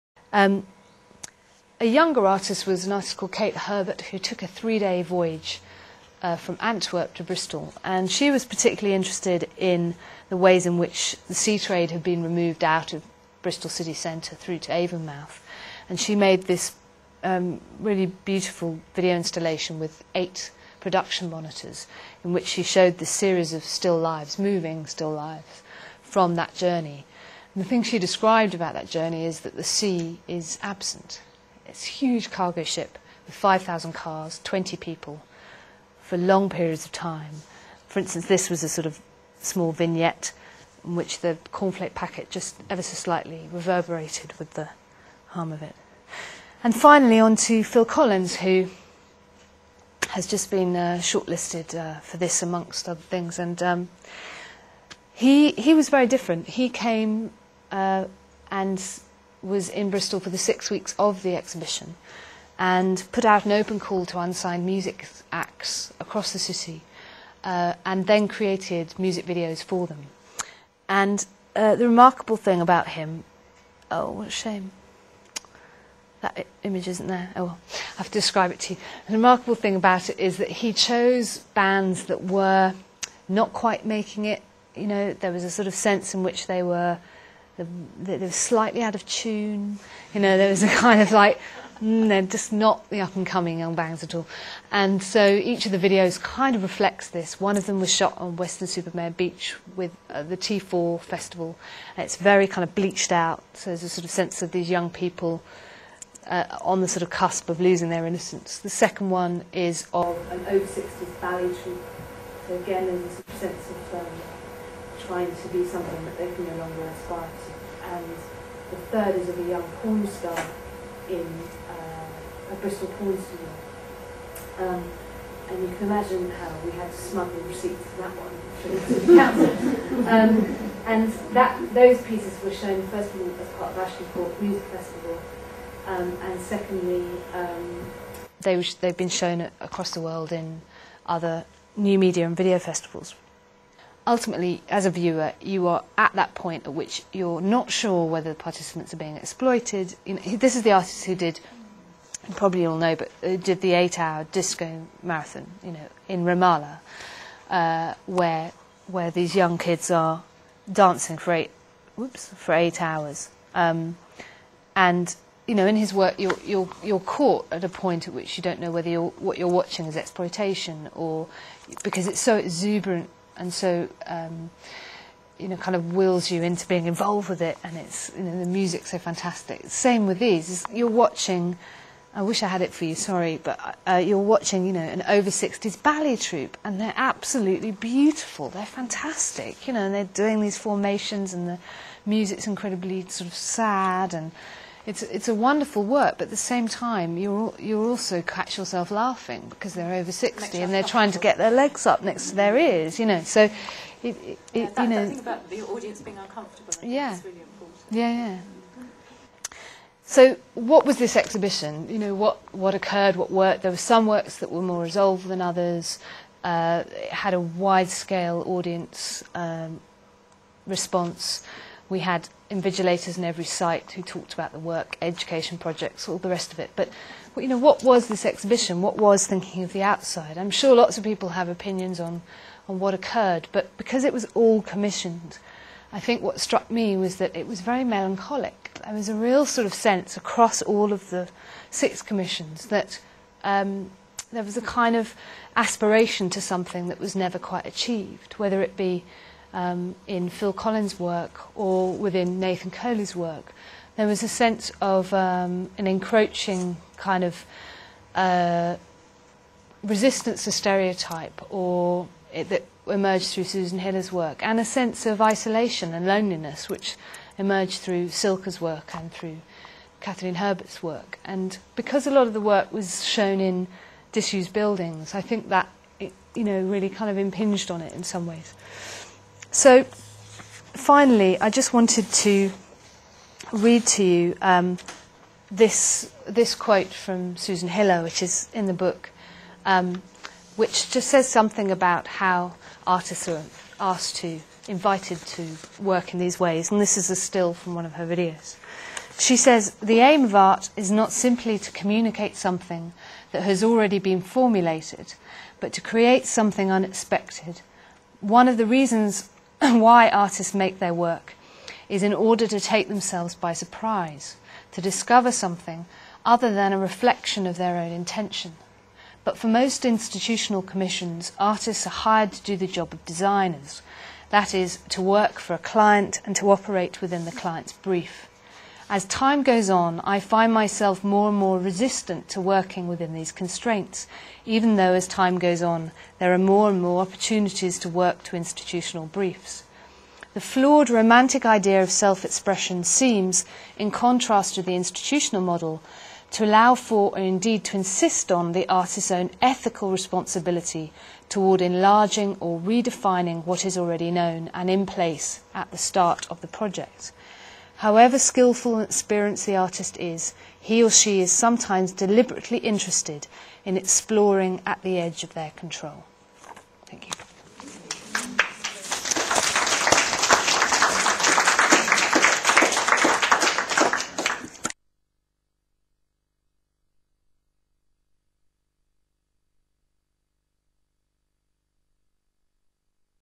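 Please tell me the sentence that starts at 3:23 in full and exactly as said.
So, it, it, yeah, that, you know.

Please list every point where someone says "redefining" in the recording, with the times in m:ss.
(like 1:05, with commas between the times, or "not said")
5:52.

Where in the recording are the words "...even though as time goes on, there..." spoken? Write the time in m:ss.
5:34.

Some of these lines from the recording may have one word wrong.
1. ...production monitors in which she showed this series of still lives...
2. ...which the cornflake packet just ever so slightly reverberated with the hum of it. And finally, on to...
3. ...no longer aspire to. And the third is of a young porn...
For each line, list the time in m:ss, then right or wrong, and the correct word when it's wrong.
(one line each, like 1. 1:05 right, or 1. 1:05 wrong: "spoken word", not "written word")
1. 0:20 right
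2. 0:40 right
3. 1:56 right.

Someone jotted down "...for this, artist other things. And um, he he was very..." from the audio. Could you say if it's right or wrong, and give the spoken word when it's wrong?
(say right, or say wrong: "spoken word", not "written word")
wrong: "amongst", not "artist".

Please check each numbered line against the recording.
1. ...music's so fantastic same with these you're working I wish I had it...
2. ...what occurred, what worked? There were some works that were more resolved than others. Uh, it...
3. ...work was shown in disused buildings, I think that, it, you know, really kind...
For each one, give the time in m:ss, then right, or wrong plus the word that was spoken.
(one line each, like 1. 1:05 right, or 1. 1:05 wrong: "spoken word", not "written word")
1. 2:58 wrong: "watching", not "working"
2. 3:32 right
3. 4:32 right.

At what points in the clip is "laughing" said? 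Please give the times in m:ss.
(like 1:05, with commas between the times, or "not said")
3:18.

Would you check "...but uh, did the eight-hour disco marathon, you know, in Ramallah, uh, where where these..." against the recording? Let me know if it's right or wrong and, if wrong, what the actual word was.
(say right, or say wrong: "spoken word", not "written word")
right.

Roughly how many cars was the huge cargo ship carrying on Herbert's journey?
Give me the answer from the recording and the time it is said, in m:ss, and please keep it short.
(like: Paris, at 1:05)
5,000, at 0:33.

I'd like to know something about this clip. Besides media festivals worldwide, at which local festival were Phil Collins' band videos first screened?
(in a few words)
Ashton Court Music Festival.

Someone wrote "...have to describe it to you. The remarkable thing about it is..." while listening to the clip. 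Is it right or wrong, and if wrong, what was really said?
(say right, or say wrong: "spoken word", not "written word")
right.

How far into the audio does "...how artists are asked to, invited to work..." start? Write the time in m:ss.
4:52.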